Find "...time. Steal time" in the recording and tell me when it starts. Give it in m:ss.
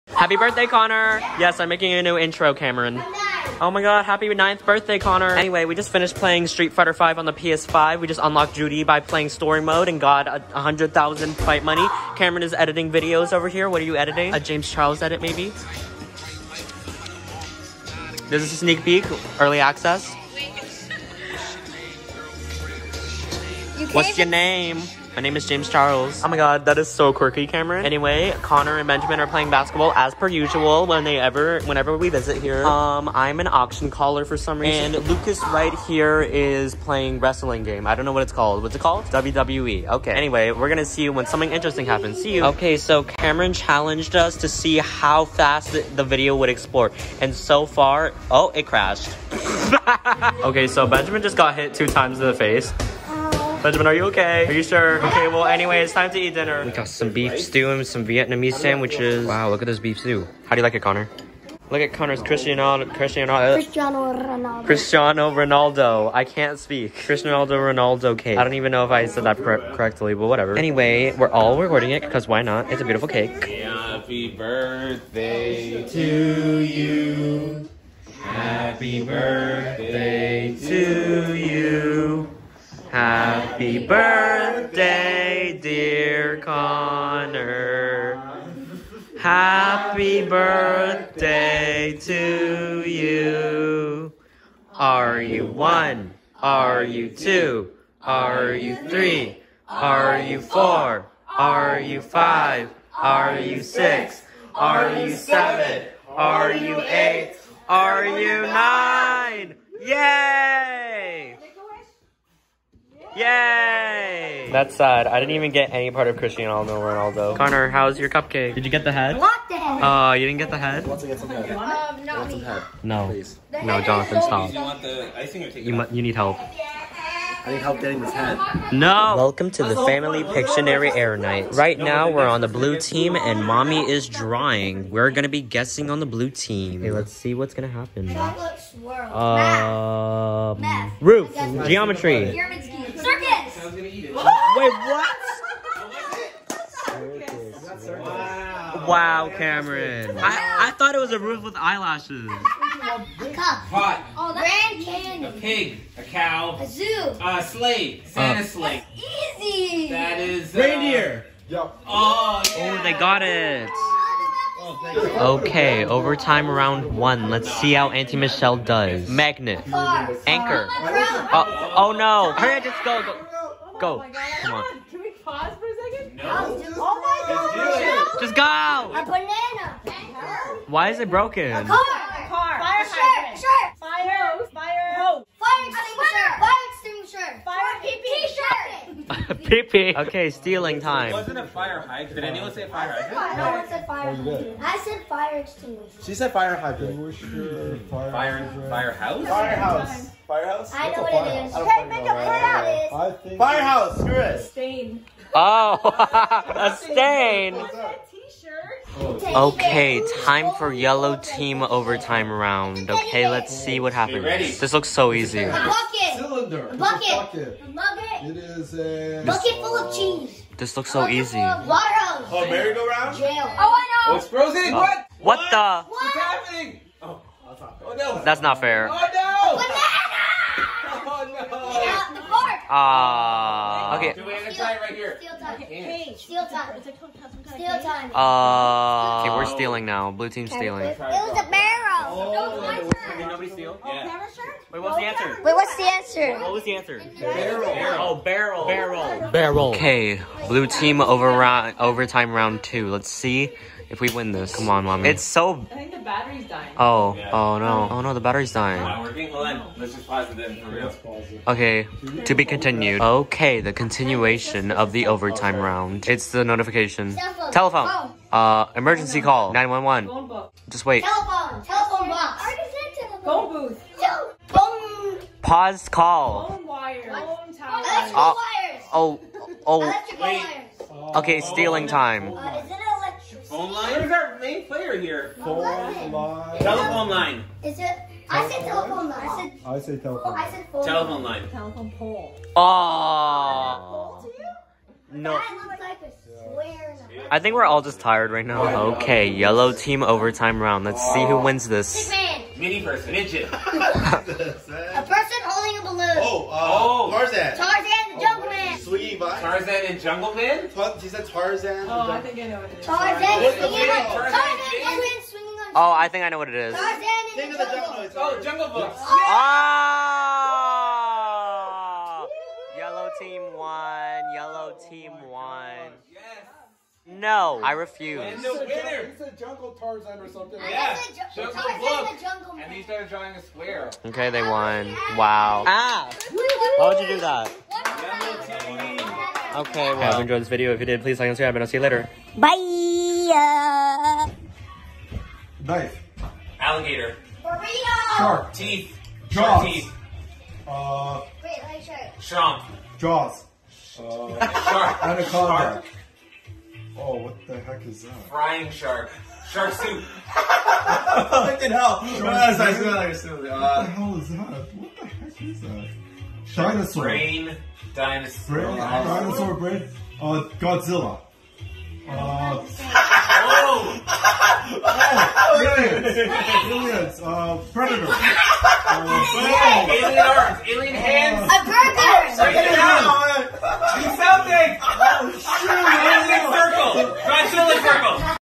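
3:56.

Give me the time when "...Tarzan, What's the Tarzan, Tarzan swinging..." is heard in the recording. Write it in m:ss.
5:13.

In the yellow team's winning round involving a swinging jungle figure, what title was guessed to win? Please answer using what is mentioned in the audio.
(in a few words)
Jungle Book.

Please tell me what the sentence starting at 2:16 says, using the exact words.
Hey, let's see what's gonna happen.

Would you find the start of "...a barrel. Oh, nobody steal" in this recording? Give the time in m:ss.
4:01.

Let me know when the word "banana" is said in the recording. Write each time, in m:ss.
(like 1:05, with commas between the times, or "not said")
2:59, 3:49.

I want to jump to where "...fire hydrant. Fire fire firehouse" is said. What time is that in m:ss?
3:16.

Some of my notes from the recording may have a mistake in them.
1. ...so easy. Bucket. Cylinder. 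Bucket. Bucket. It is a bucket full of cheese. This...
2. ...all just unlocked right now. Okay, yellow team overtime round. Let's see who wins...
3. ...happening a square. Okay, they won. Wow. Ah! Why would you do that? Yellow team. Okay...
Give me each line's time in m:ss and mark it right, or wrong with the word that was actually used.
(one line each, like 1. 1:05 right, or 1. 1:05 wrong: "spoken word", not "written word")
1. 3:34 right
2. 4:57 wrong: "tired", not "unlocked"
3. 5:33 wrong: "drawing", not "happening".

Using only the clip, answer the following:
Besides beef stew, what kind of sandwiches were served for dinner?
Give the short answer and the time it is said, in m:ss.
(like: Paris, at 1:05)
Vietnamese sandwiches, at 0:58.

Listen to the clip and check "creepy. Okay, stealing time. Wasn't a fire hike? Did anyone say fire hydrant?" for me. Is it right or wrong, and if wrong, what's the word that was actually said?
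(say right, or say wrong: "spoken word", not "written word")
right.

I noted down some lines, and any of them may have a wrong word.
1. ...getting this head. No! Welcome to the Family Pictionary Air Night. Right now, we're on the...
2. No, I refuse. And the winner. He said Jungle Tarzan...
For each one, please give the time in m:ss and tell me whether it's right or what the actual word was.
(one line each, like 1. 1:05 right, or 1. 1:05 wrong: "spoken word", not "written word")
1. 2:07 right
2. 5:27 right.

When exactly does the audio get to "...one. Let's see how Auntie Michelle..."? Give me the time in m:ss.
2:46.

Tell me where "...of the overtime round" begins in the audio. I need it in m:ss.
4:24.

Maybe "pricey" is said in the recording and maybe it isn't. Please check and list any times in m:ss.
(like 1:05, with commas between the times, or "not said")
not said.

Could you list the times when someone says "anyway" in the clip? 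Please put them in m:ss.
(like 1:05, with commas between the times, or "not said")
0:05, 0:27, 0:40, 0:55, 1:10.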